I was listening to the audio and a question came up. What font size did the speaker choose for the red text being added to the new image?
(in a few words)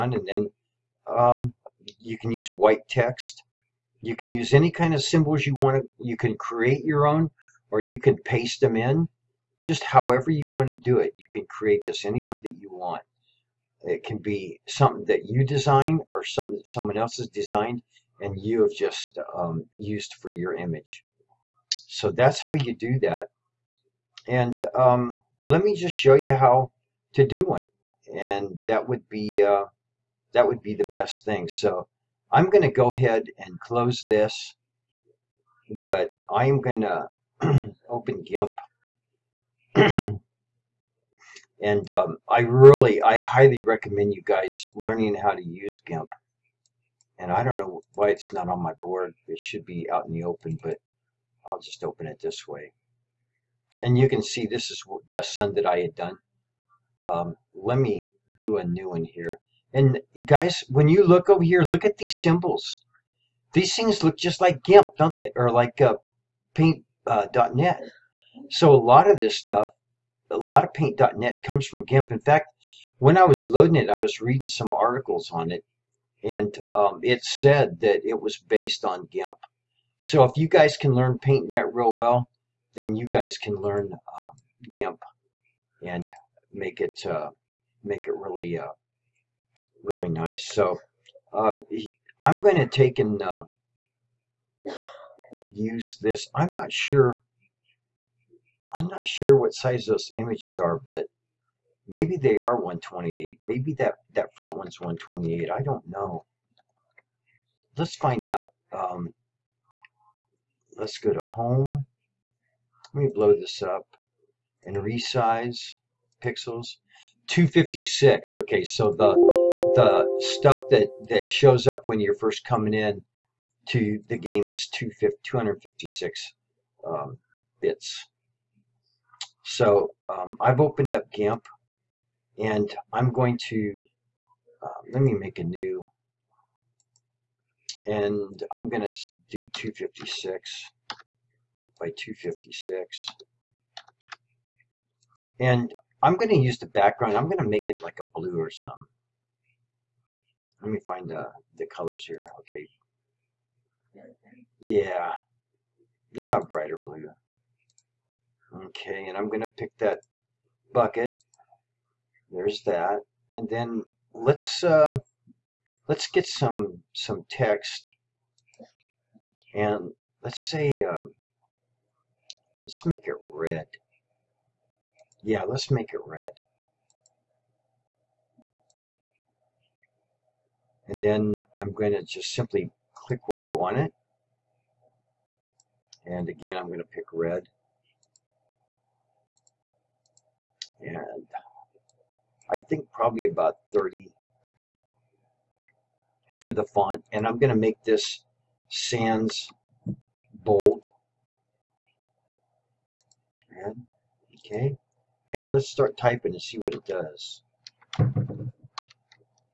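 30.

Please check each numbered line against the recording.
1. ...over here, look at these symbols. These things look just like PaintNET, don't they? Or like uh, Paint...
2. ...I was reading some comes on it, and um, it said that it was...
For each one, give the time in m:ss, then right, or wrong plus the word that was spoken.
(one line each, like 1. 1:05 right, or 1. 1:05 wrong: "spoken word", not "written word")
1. 1:01 wrong: "GIMP", not "PaintNET"
2. 1:13 wrong: "articles", not "comes".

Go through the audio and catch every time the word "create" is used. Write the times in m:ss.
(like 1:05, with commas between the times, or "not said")
0:06, 0:11.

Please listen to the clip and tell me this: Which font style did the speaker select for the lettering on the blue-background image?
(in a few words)
Sans bold.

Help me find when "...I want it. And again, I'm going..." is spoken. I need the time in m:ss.
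3:03.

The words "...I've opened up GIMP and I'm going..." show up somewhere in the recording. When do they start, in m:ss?
2:10.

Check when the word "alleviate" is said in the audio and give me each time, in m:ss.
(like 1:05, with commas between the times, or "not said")
not said.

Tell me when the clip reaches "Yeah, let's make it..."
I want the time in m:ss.
2:55.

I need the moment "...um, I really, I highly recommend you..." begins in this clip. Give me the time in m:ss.
0:41.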